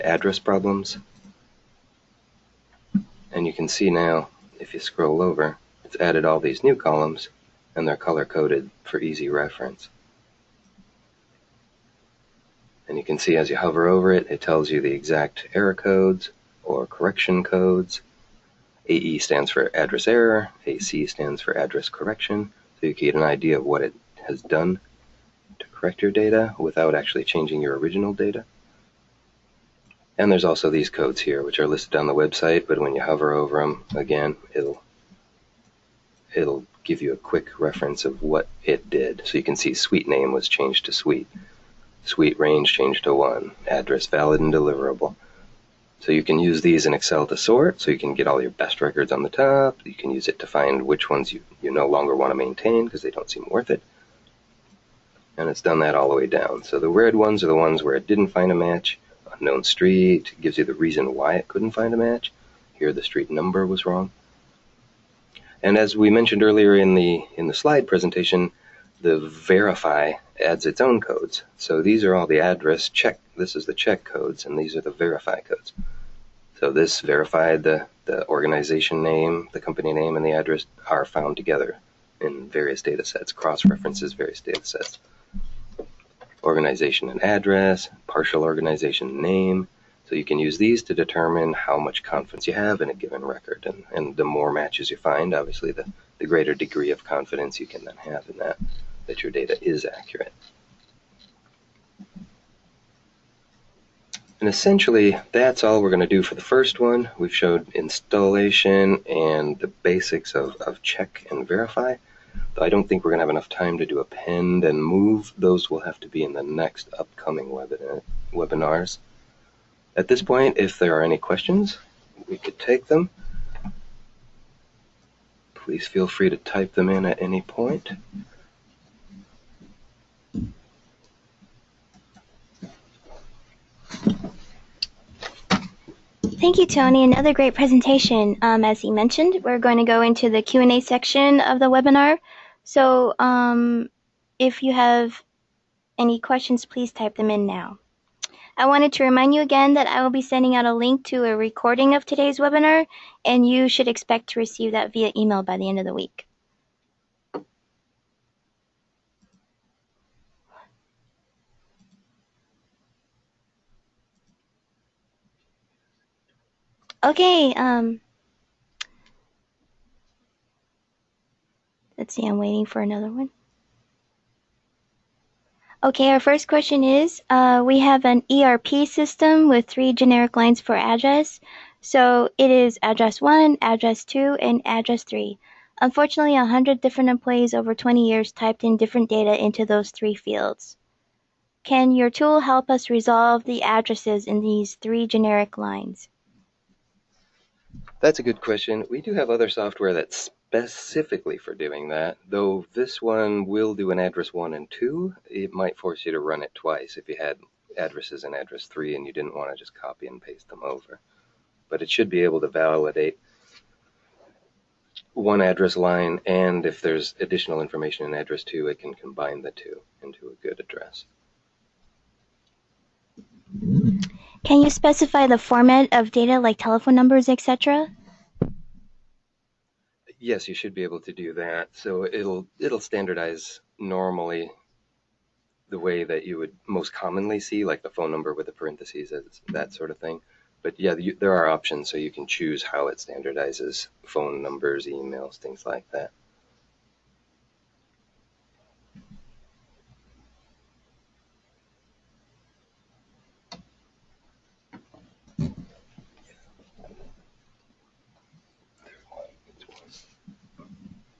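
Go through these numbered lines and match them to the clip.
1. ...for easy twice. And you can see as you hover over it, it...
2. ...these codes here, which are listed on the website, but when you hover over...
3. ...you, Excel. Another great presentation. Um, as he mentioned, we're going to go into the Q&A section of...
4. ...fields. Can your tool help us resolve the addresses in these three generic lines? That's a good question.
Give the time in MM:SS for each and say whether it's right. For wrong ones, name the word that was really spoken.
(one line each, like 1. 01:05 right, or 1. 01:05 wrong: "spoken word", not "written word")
1. 00:08 wrong: "reference", not "twice"
2. 00:30 right
3. 02:16 wrong: "Tony", not "Excel"
4. 03:10 right.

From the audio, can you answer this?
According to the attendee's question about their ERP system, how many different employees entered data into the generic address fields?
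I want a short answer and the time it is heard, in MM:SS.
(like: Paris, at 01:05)
100, at 03:06.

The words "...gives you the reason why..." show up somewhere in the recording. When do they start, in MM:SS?
01:00.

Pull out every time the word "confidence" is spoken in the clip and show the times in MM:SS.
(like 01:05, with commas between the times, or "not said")
01:32, 01:37.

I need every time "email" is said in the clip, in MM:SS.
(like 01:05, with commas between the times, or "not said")
02:35, 04:04.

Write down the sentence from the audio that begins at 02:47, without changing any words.
Okay, um, let's see, I'm waiting for another one.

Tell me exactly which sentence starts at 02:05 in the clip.
Please feel free to type them in at any point.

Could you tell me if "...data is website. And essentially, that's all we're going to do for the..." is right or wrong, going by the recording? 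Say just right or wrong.
wrong.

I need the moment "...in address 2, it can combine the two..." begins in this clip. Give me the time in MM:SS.
03:38.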